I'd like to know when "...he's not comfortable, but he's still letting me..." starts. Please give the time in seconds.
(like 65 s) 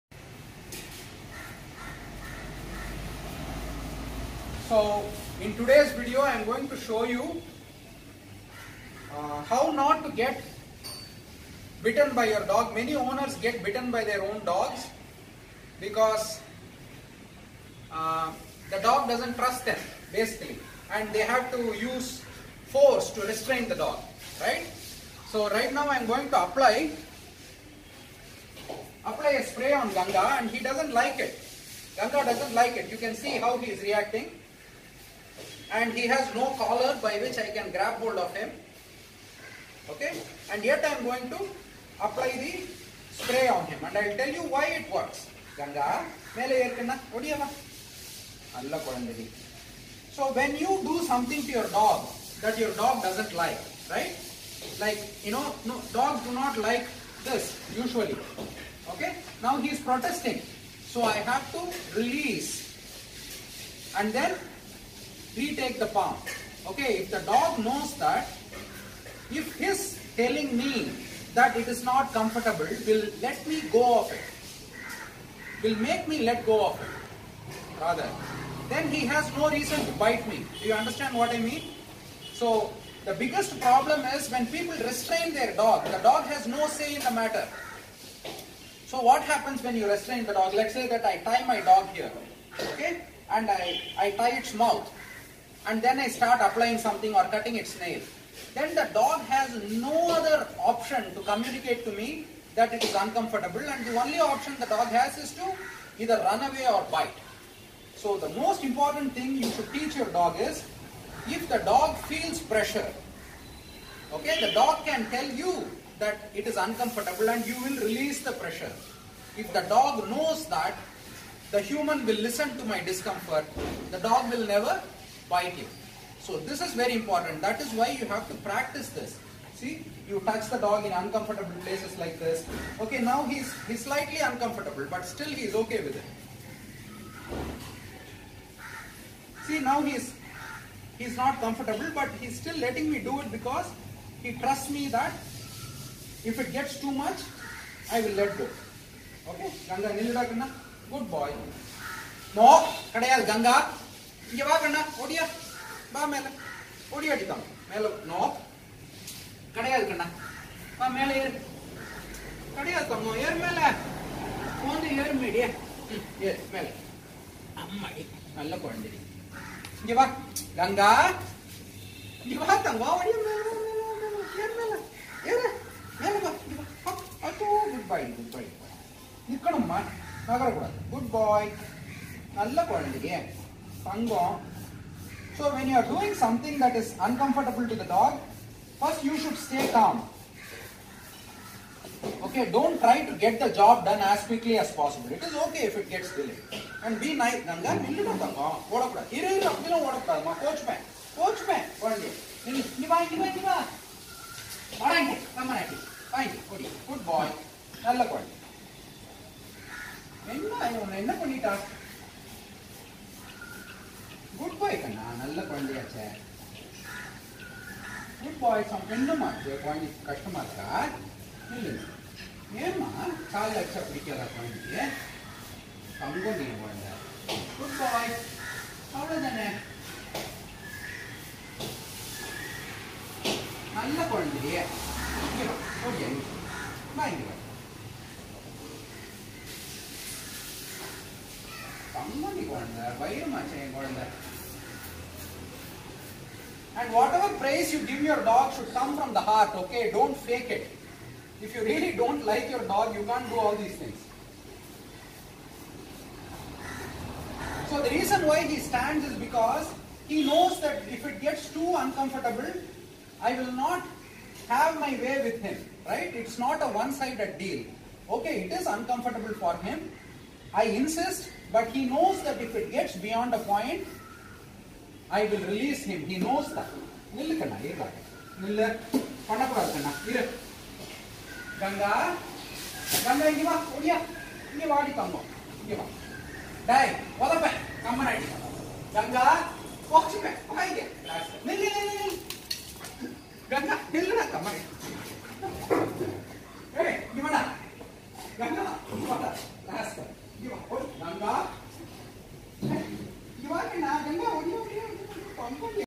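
140 s.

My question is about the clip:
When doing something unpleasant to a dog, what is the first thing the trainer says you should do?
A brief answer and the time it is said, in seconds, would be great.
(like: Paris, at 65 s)
stay calm, at 189 s.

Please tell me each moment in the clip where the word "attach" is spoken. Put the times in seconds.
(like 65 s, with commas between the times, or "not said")
not said.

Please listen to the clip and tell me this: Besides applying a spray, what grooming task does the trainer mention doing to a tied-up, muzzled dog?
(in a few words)
cutting its nail.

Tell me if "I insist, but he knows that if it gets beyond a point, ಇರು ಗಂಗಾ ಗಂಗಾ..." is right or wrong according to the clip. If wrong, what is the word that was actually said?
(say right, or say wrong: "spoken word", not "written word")
right.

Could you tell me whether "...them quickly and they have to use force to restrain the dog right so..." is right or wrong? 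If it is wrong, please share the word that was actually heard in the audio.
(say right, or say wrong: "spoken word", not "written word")
wrong: "basically", not "quickly".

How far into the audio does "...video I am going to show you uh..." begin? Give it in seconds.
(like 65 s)
5 s.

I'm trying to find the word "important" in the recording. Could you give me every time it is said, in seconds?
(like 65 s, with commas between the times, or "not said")
108 s, 126 s.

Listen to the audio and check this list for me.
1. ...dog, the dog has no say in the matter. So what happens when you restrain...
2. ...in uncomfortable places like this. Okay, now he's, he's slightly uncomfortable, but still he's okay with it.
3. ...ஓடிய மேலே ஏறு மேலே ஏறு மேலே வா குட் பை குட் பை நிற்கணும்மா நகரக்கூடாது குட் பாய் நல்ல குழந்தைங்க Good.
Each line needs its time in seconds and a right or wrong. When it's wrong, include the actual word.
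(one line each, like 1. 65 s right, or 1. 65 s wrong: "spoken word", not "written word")
1. 85 s right
2. 130 s right
3. 173 s wrong: "Sangha", not "Good".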